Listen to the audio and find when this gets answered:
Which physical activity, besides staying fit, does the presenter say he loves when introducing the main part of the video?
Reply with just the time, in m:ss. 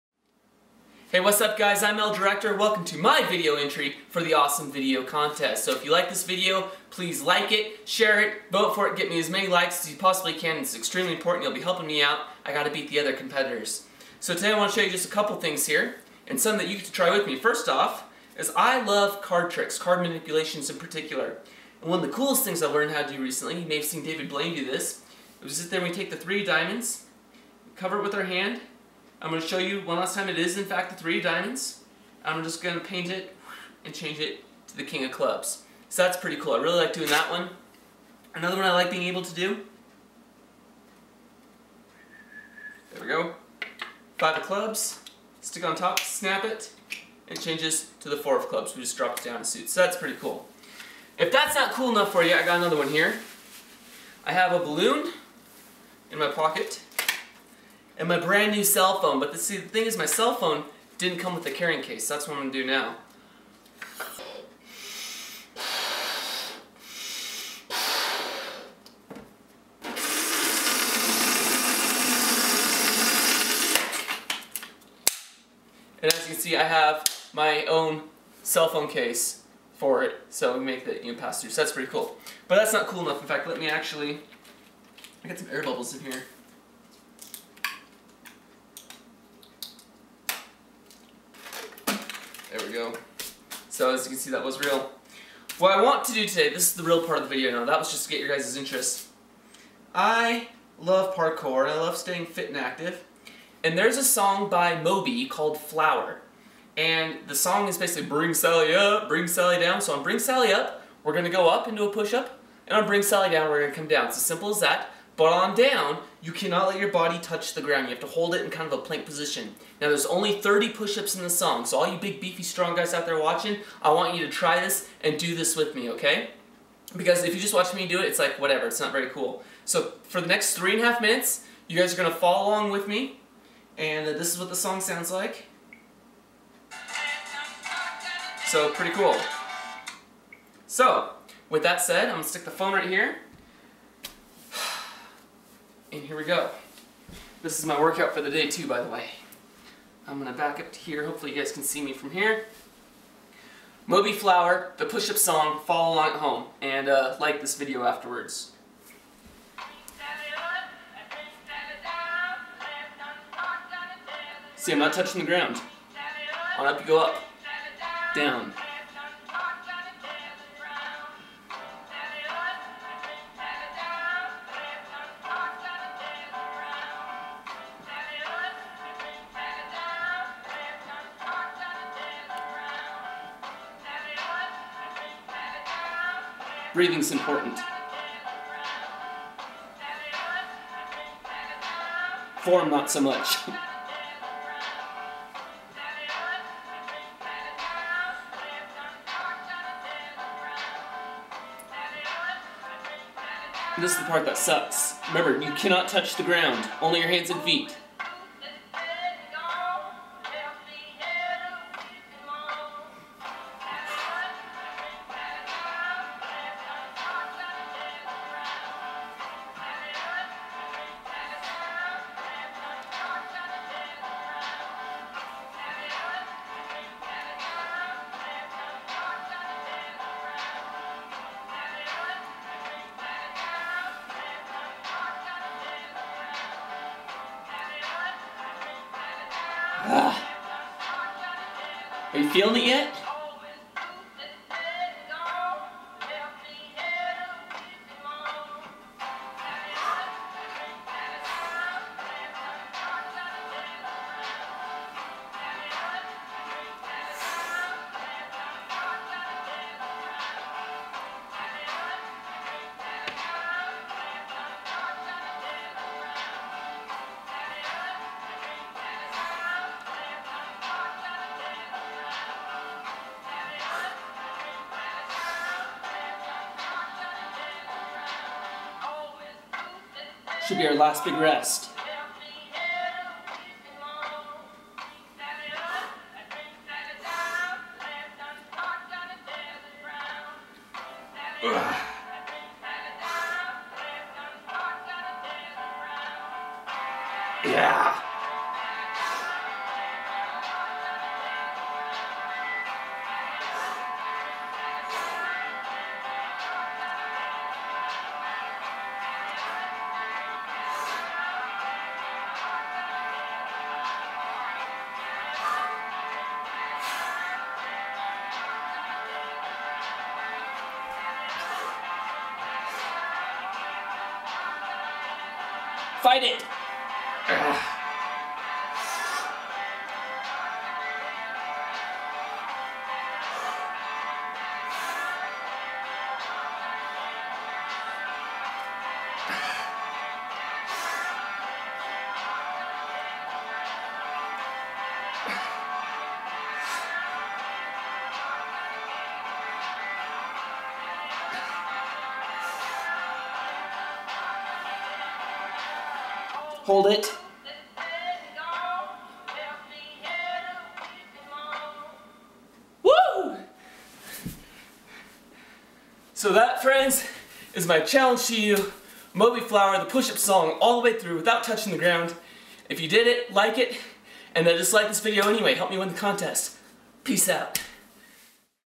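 1:41.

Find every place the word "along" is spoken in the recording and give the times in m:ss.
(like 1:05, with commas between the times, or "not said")
2:12, 2:35.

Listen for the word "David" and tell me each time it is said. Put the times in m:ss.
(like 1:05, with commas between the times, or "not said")
0:24.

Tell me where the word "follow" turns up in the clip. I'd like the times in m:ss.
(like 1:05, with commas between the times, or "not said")
2:12, 2:35.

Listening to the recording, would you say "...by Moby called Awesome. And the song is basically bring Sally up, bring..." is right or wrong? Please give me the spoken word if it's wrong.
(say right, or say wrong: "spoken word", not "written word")
wrong: "Flower", not "Awesome".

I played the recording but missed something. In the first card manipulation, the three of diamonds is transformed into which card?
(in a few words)
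King of clubs.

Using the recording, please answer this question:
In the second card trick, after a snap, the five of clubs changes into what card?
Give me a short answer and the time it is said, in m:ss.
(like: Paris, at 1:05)
Four of clubs, at 0:48.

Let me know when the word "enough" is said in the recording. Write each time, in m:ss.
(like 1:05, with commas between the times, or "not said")
0:51, 1:23.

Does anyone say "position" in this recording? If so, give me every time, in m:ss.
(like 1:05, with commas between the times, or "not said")
1:59.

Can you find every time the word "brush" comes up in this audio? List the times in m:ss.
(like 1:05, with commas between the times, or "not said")
not said.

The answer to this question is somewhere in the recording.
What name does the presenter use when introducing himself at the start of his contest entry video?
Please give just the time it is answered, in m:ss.
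0:01.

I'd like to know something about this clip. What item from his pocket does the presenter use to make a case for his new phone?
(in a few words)
A balloon.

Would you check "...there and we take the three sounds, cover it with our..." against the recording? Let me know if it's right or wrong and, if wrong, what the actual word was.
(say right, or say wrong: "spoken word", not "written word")
wrong: "diamonds", not "sounds".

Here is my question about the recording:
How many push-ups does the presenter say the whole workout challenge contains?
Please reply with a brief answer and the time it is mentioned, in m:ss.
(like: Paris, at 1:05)
30, at 2:00.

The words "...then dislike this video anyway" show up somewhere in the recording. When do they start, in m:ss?
6:14.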